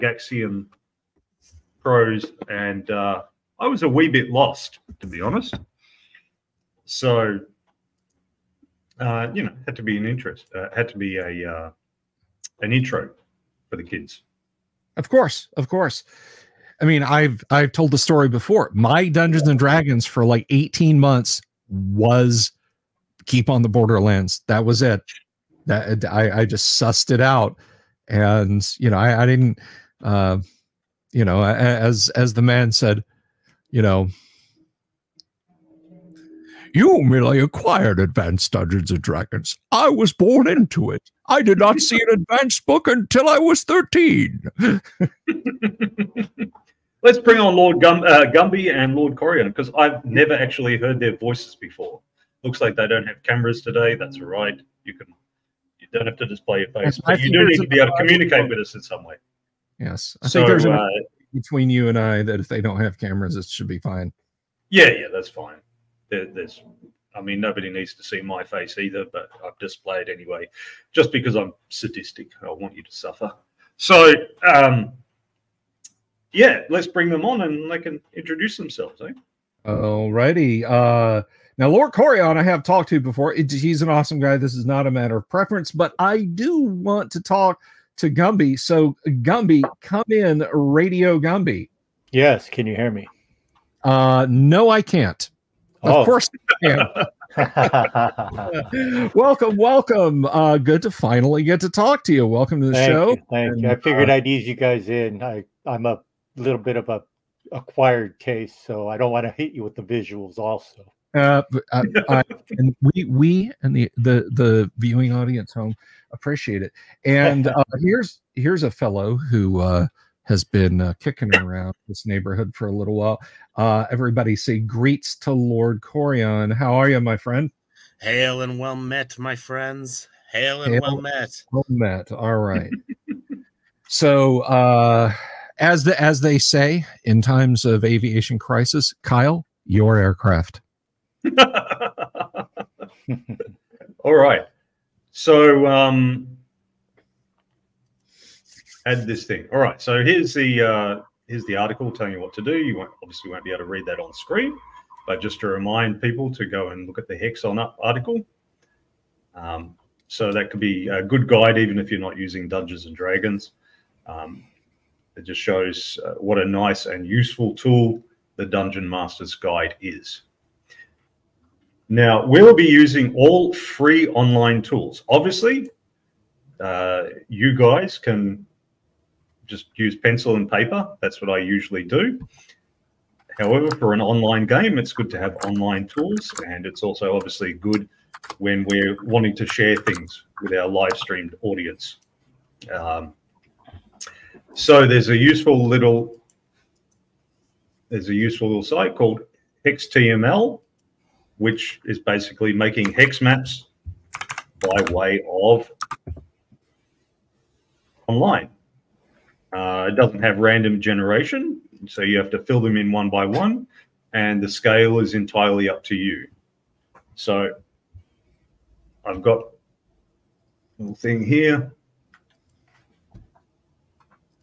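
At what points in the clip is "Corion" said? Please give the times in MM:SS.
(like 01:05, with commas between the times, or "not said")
00:49, 01:21, 02:05.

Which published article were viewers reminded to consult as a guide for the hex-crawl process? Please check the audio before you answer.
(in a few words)
Hexon Up.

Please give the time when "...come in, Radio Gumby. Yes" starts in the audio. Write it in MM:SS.
01:29.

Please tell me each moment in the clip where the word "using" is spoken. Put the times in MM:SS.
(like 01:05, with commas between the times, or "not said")
02:42, 02:52.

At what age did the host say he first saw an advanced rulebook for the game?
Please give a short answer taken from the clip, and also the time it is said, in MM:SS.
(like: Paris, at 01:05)
13, at 00:43.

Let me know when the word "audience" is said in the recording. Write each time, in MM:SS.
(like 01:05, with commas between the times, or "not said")
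01:55, 03:11.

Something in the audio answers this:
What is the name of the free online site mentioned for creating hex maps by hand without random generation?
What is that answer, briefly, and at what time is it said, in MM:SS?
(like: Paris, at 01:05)
HexTML, at 03:19.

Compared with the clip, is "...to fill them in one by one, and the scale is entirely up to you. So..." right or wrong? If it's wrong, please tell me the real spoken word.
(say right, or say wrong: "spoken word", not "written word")
right.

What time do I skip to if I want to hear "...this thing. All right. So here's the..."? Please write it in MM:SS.
02:29.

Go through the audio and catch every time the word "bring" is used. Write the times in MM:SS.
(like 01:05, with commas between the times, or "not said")
00:47, 01:16.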